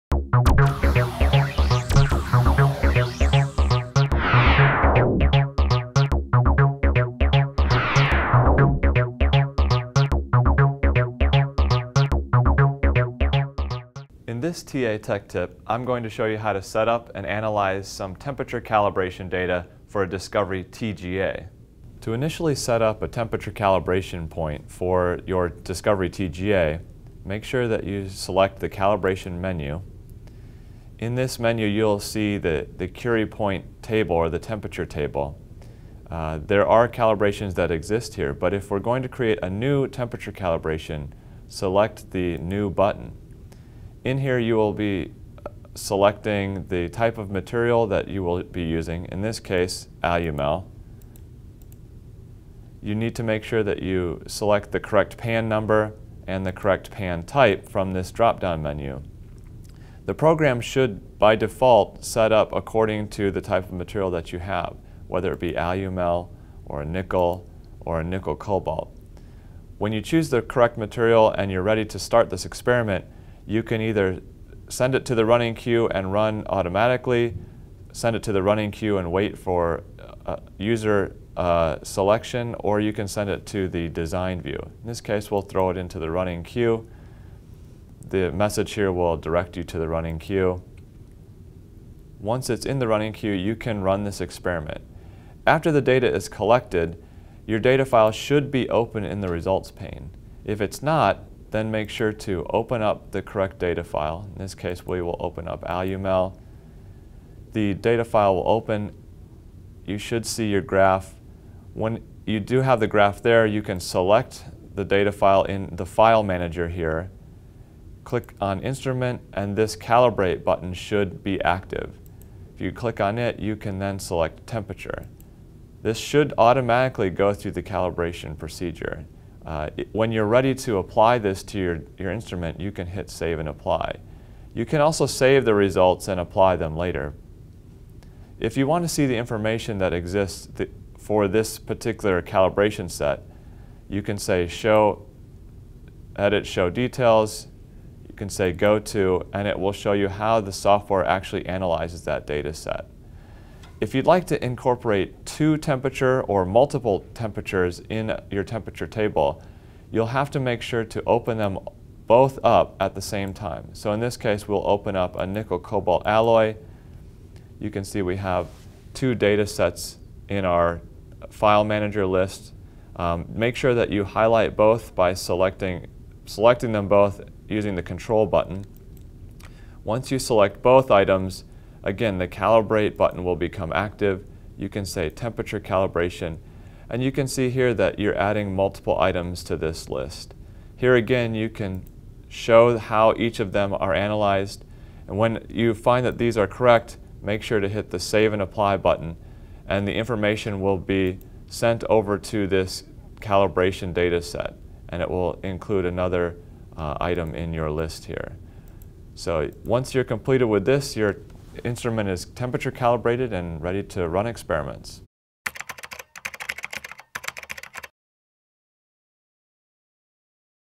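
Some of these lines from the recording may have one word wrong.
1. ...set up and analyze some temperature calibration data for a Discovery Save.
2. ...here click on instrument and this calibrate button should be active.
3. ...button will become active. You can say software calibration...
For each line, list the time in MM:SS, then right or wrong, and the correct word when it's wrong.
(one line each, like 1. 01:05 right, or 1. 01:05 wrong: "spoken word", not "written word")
1. 00:16 wrong: "TGA", not "Save"
2. 01:56 right
3. 03:02 wrong: "temperature", not "software".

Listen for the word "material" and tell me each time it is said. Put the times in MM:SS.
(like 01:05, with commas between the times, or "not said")
00:47, 01:03, 01:10.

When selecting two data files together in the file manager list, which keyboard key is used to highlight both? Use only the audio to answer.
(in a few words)
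Control.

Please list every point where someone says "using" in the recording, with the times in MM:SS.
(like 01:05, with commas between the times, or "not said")
00:48, 02:57.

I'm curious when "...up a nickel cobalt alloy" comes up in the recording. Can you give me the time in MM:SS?
02:44.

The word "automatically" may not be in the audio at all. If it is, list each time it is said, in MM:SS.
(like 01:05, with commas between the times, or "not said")
01:16, 02:06.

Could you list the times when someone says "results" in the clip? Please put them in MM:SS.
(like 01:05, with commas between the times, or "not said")
01:39, 02:15.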